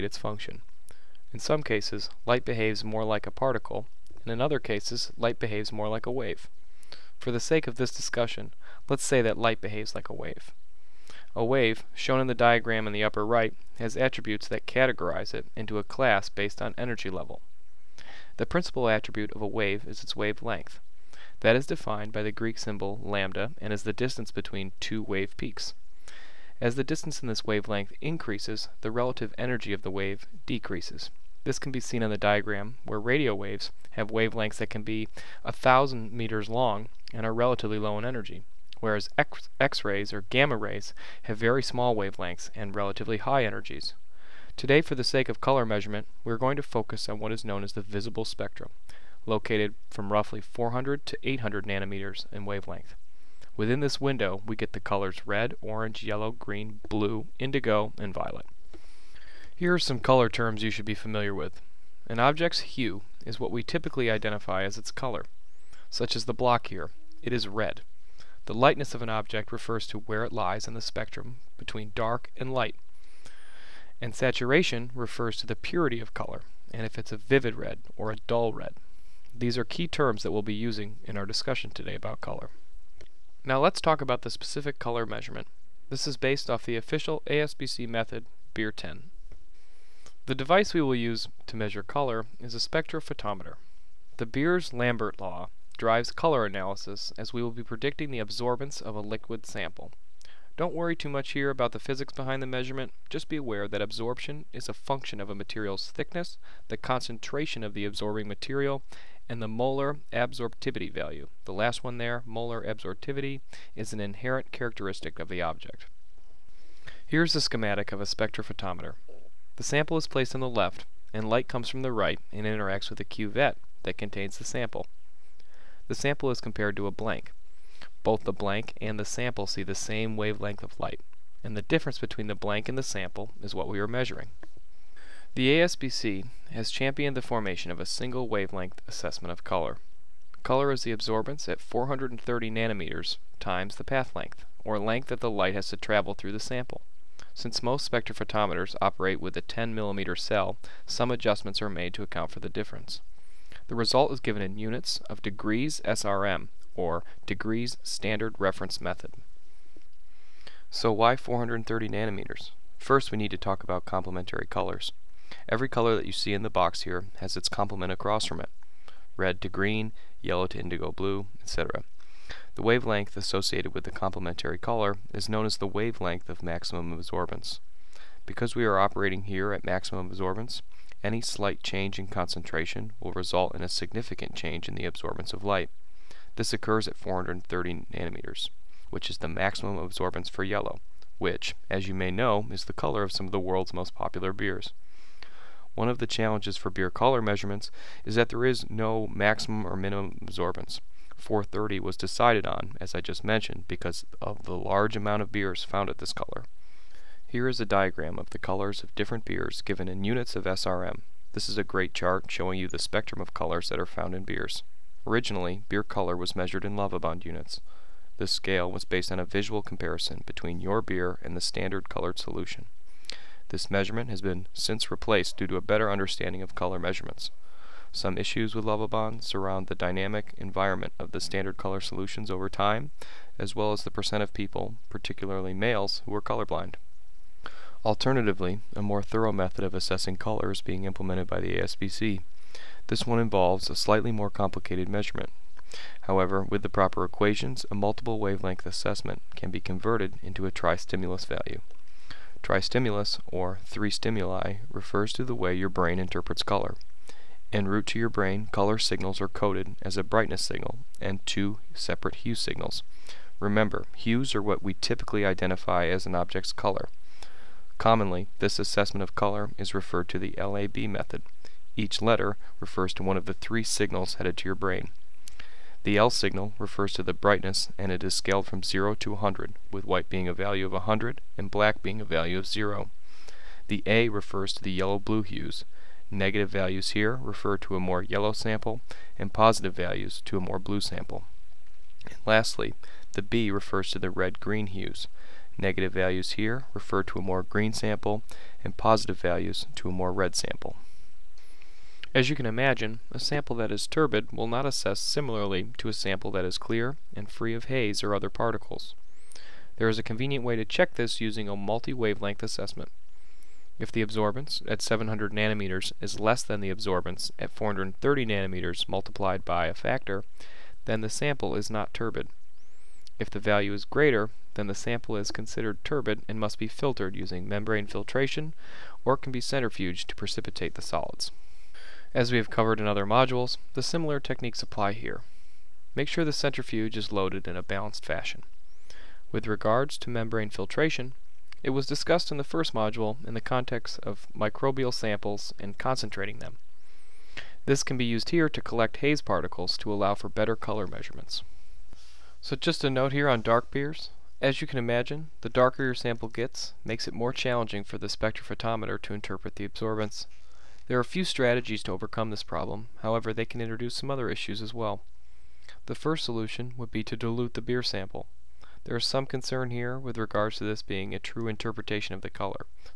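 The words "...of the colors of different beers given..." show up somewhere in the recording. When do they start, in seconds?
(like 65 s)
208 s.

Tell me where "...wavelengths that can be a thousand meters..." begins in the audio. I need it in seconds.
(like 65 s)
34 s.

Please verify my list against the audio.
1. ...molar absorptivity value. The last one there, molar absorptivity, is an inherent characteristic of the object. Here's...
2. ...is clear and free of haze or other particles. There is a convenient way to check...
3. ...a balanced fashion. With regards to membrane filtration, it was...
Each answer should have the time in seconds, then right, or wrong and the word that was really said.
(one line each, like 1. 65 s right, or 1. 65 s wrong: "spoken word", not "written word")
1. 109 s right
2. 306 s right
3. 337 s right.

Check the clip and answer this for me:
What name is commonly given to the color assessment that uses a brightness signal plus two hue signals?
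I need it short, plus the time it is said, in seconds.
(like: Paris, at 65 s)
LAB method, at 270 s.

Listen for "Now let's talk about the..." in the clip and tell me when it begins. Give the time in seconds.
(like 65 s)
83 s.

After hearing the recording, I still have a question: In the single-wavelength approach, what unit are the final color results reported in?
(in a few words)
degrees SRM.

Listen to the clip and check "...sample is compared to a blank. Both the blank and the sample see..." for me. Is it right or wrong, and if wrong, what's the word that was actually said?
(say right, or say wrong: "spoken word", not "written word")
right.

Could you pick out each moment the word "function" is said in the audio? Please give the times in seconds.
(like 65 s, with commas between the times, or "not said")
0 s, 104 s.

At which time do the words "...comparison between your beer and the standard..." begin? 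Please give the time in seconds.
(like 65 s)
219 s.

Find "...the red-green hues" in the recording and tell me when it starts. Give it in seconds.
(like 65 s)
293 s.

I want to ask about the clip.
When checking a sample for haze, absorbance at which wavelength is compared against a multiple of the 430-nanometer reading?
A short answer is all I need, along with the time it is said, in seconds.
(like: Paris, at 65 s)
700 nanometers, at 314 s.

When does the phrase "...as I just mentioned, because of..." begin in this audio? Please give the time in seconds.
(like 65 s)
202 s.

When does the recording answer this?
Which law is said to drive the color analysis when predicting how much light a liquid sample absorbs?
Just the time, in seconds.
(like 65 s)
94 s.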